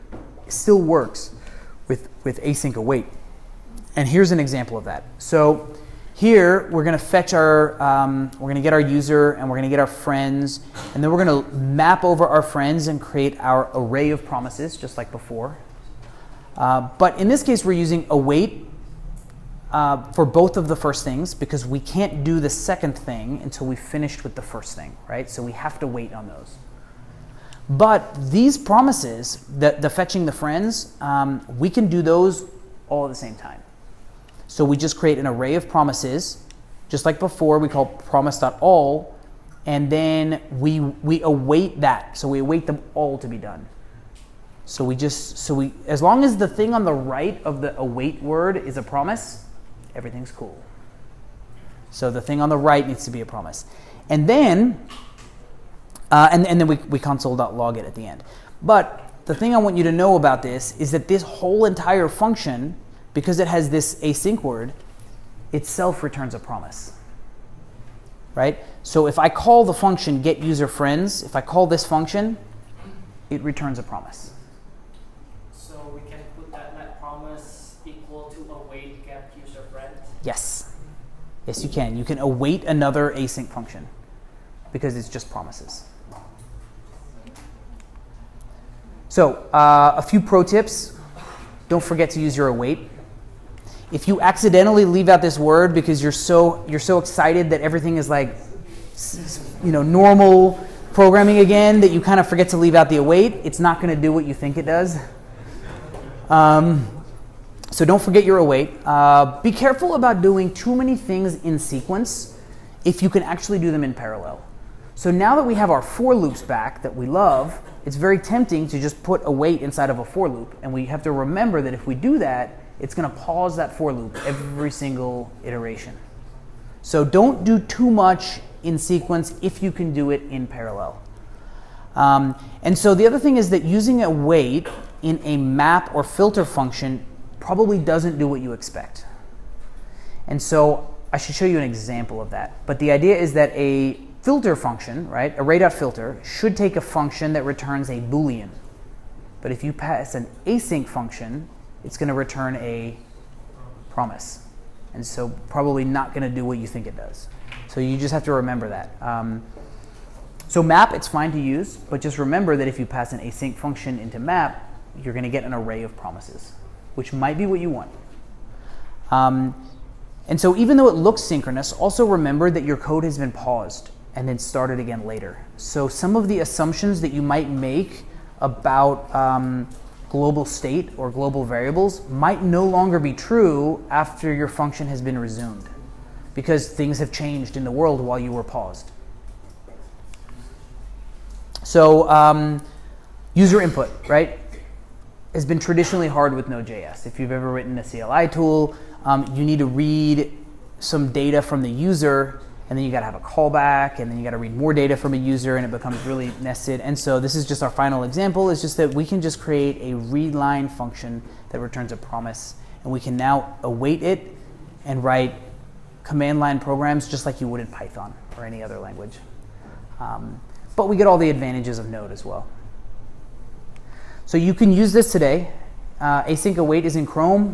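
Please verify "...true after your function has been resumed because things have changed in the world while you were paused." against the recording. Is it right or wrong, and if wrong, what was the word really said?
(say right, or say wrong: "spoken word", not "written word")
right.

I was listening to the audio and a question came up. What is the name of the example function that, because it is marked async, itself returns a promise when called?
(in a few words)
get user friends.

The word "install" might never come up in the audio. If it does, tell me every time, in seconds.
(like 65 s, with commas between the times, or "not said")
not said.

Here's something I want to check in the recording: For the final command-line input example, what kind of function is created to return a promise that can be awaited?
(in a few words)
readline function.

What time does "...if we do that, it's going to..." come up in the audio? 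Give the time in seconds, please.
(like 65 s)
121 s.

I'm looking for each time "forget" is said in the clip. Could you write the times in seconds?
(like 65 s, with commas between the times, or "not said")
91 s, 102 s, 108 s.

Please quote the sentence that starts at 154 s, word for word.
And so probably not going to do what you think it does.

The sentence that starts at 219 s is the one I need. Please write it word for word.
Um, but we get all the advantages of Node as well.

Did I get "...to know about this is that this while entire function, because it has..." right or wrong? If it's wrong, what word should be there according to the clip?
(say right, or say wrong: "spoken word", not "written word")
wrong: "whole", not "while".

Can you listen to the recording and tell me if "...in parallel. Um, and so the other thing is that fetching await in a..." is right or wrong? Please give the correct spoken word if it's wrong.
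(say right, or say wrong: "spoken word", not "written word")
wrong: "using", not "fetching".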